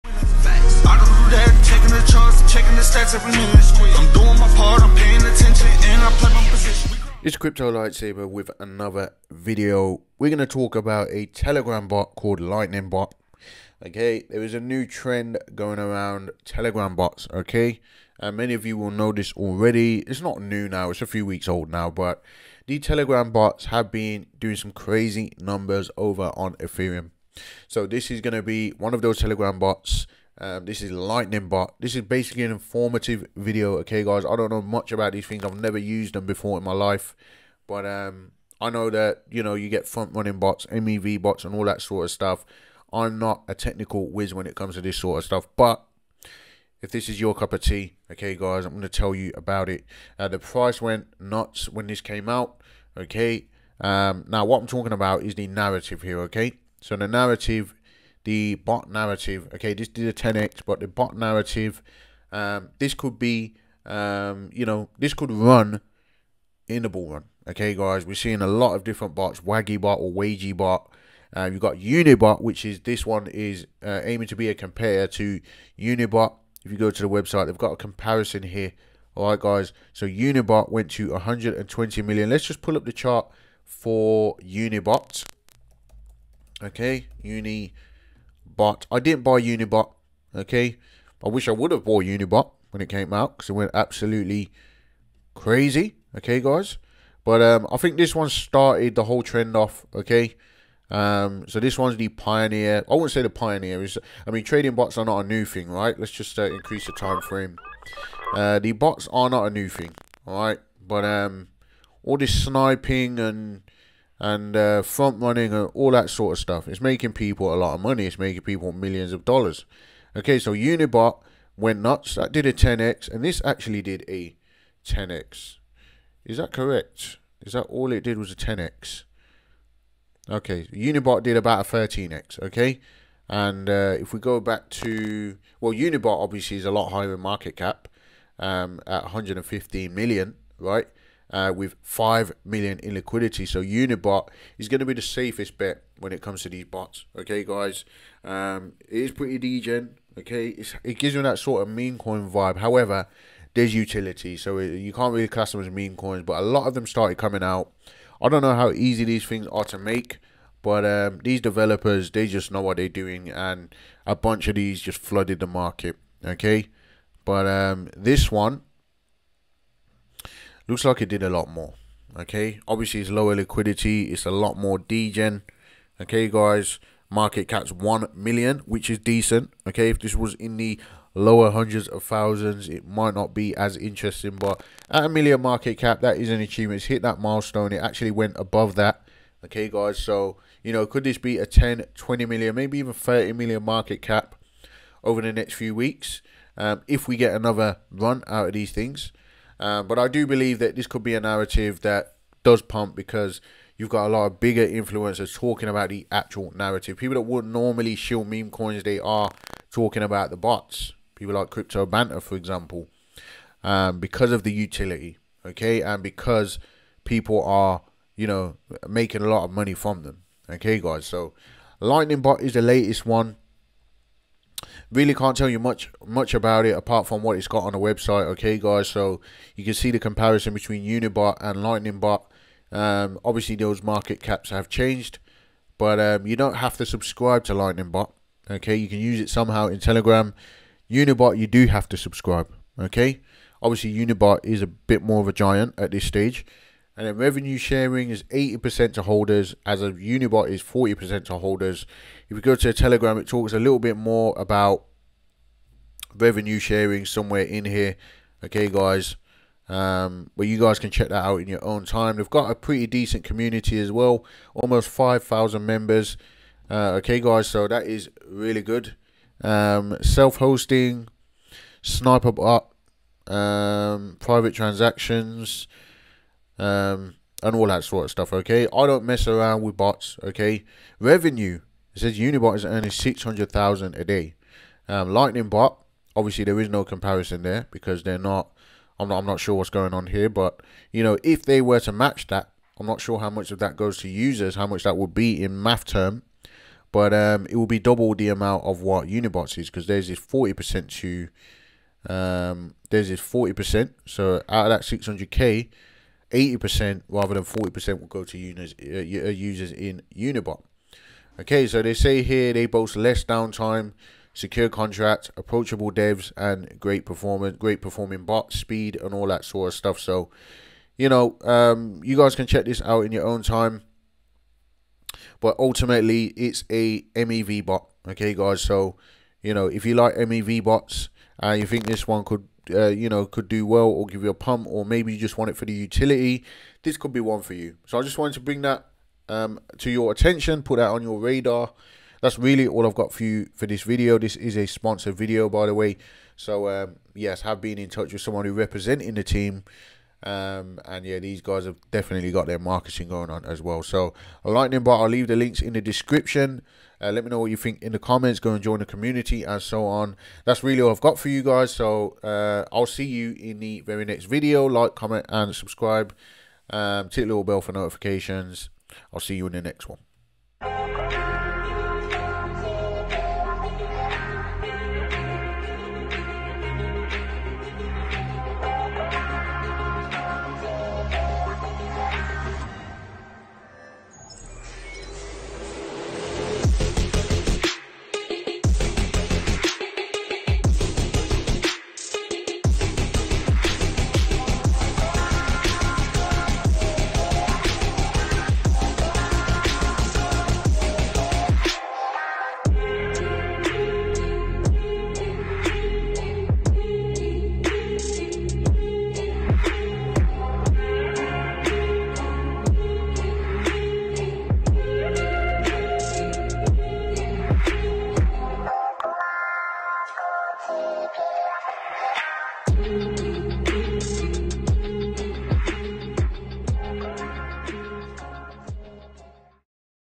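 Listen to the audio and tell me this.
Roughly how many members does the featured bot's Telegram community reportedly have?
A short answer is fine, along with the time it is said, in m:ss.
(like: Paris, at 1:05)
almost 5,000, at 4:24.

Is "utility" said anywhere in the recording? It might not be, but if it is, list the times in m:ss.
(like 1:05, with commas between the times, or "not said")
2:33, 3:34, 5:35.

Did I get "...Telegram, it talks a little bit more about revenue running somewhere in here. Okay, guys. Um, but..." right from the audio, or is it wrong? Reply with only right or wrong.
wrong.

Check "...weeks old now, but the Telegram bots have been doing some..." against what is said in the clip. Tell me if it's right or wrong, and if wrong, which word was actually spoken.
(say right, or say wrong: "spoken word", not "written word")
right.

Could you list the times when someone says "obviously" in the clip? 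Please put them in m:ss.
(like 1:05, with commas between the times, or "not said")
2:16, 2:52, 3:53, 4:03, 4:46.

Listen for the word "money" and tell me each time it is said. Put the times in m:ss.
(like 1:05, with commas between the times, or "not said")
1:57, 3:39.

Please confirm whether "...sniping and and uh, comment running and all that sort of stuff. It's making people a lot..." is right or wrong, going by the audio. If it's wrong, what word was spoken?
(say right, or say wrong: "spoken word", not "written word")
wrong: "front", not "comment".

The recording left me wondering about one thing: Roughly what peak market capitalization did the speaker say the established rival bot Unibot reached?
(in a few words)
120 million.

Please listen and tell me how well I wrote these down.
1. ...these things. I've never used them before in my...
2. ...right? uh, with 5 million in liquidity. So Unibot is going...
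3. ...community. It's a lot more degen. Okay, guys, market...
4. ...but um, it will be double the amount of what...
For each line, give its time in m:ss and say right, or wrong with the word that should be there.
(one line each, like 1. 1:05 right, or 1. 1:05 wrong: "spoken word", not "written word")
1. 0:35 right
2. 2:20 right
3. 2:53 wrong: "liquidity", not "community"
4. 4:56 right.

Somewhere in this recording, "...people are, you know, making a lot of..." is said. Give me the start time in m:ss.
3:37.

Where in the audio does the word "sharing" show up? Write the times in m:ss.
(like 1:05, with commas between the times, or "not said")
4:07, 4:16.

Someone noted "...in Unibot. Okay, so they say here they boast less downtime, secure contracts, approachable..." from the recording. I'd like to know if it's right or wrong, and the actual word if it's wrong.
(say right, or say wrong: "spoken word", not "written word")
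right.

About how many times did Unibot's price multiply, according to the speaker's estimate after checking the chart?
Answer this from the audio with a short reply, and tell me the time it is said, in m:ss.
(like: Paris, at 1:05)
13x, at 2:11.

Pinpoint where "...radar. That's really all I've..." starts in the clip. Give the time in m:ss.
5:41.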